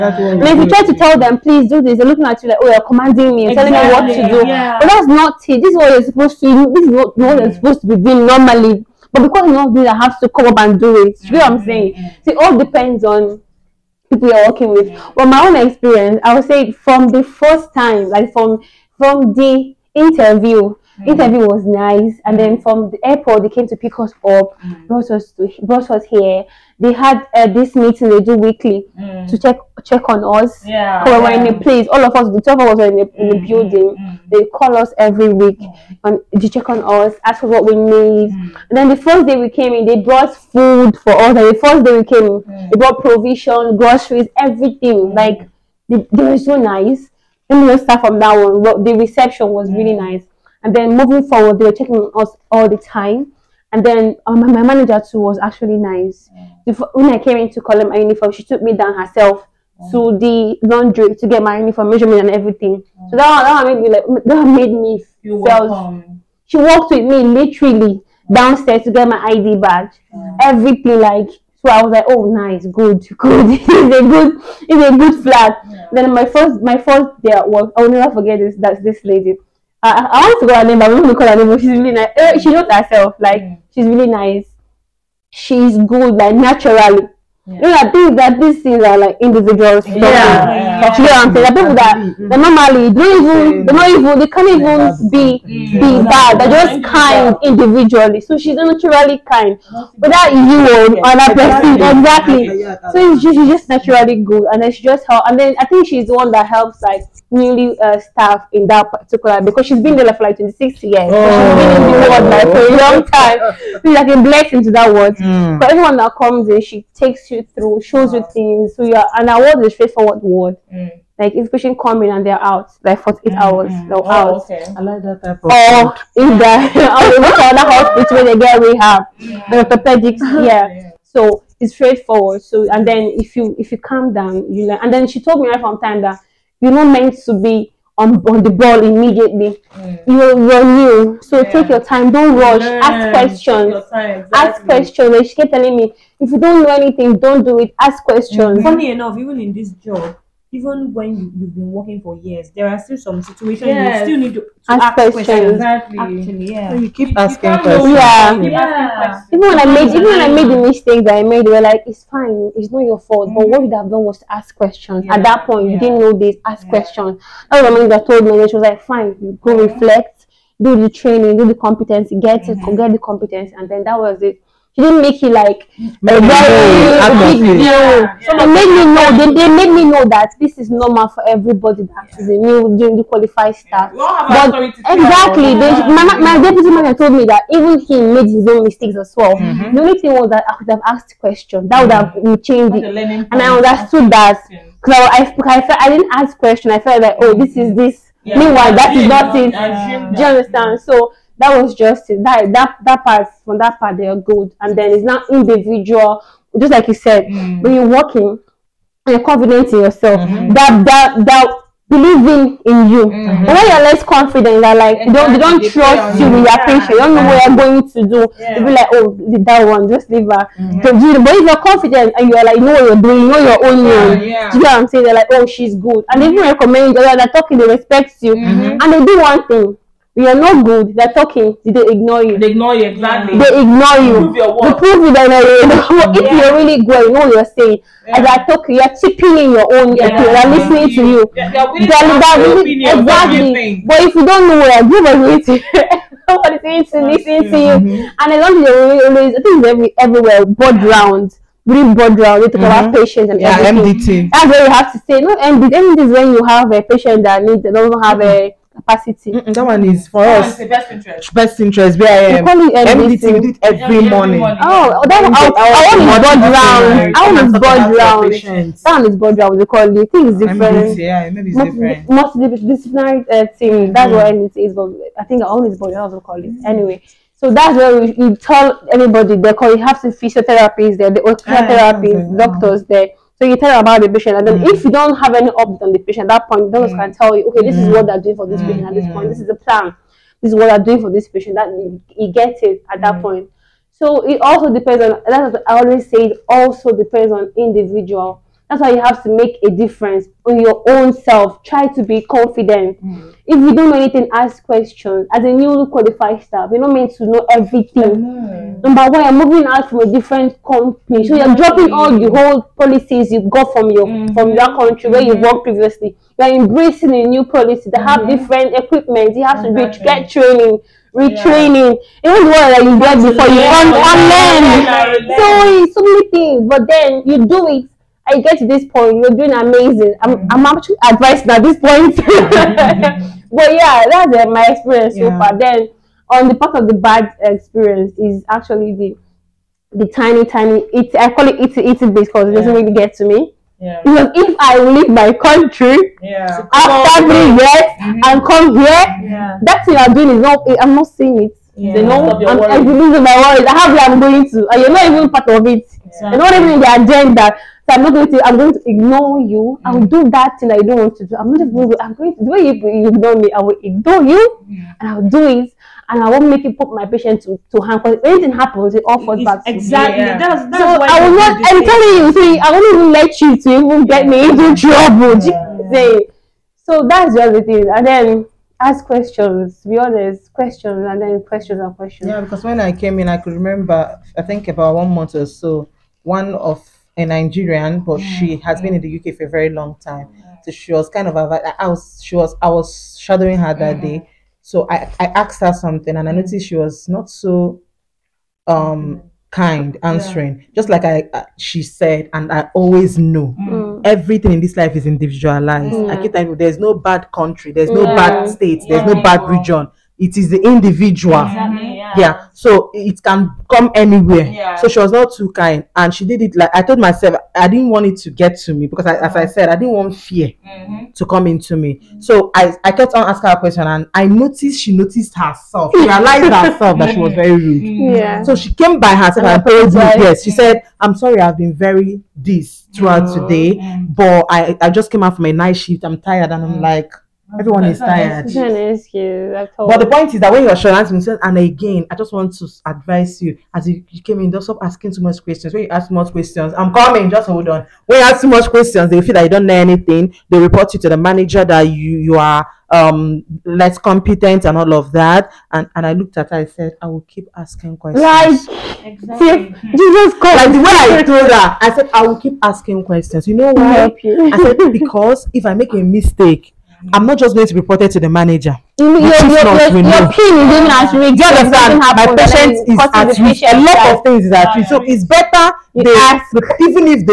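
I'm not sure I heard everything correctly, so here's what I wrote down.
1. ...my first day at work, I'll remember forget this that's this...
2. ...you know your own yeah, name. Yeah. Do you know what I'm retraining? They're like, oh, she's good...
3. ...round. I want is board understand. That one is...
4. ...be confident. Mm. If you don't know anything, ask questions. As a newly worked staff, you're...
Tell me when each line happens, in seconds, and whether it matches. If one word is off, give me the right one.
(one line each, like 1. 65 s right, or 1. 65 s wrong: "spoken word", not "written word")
1. 76 s wrong: "never", not "remember"
2. 223 s wrong: "saying", not "retraining"
3. 267 s wrong: "round", not "understand"
4. 302 s wrong: "qualified", not "worked".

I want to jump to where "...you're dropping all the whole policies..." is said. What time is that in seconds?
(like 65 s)
311 s.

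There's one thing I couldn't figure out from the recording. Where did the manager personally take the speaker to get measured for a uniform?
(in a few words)
The laundry.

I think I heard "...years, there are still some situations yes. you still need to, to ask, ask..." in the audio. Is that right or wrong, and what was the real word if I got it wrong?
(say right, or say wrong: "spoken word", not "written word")
right.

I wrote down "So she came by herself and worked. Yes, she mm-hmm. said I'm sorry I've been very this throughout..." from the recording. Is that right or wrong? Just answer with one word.
wrong.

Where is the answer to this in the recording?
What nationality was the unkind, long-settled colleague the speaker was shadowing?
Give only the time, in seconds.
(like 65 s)
387 s.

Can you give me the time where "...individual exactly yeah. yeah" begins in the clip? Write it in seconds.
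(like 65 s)
410 s.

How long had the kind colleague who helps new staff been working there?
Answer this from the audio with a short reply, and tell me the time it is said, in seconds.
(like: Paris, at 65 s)
26 years, at 110 s.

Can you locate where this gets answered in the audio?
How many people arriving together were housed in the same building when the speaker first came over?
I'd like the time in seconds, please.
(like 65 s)
32 s.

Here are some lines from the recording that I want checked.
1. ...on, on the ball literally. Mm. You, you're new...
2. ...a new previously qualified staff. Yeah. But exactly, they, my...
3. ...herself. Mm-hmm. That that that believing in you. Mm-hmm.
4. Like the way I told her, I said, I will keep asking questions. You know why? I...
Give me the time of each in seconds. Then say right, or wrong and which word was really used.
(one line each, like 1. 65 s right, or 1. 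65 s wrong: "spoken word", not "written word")
1. 138 s wrong: "immediately", not "literally"
2. 182 s wrong: "newly", not "previously"
3. 209 s wrong: "yourself", not "herself"
4. 460 s right.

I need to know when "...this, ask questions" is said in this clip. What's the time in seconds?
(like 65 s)
166 s.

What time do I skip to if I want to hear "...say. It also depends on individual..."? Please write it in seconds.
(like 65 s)
296 s.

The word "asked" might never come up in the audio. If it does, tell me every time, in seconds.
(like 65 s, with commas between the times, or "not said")
190 s, 395 s.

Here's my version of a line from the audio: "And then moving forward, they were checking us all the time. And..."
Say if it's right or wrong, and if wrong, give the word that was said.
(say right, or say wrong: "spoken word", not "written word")
right.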